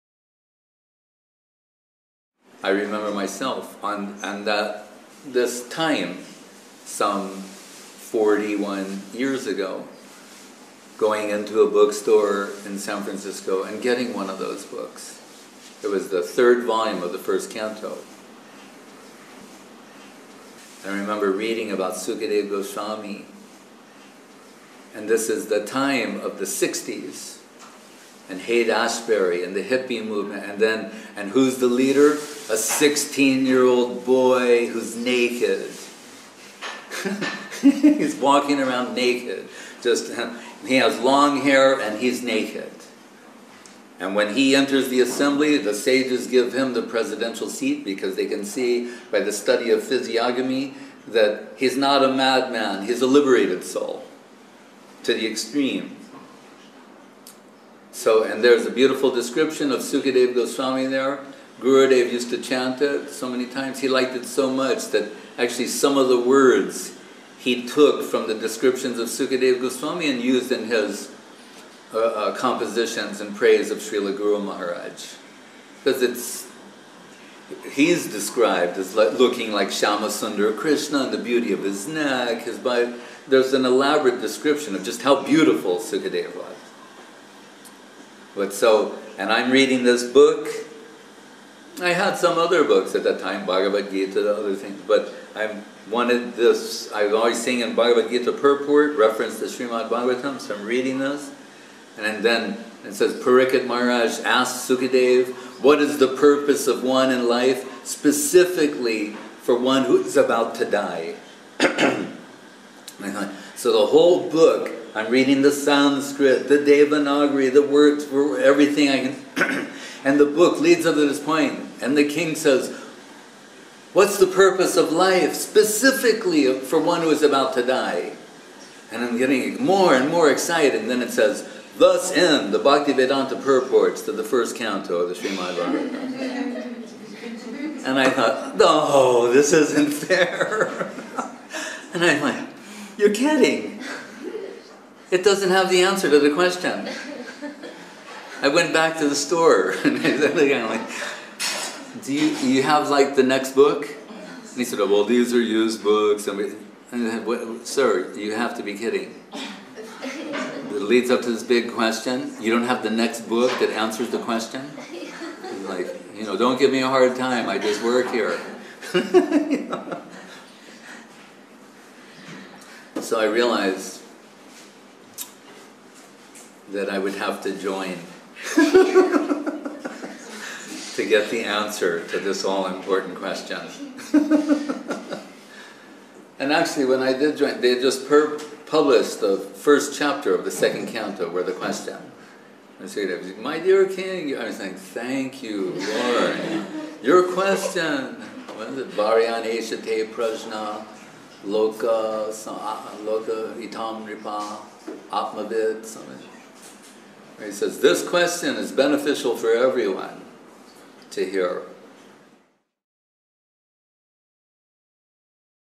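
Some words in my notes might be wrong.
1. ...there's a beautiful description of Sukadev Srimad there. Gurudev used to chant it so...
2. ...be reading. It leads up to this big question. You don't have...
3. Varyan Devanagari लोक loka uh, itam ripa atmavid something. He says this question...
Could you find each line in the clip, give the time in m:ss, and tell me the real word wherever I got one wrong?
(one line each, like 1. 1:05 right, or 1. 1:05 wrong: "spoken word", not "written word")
1. 0:58 wrong: "Goswami", not "Srimad"
2. 2:38 wrong: "kidding", not "reading"
3. 3:18 wrong: "Prajna", not "Devanagari".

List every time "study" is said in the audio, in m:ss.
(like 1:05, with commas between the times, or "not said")
0:49.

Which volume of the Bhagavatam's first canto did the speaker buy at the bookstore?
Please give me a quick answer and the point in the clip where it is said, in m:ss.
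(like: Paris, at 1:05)
third volume, at 0:16.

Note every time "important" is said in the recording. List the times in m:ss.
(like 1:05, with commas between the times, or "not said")
3:02.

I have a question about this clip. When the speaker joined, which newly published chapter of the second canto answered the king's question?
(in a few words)
first chapter.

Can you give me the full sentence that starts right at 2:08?
And I'm getting more and more excited.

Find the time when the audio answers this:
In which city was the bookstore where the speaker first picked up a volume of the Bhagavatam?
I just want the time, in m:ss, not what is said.
0:12.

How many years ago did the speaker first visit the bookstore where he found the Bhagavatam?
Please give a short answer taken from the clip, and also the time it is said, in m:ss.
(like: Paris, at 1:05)
41, at 0:07.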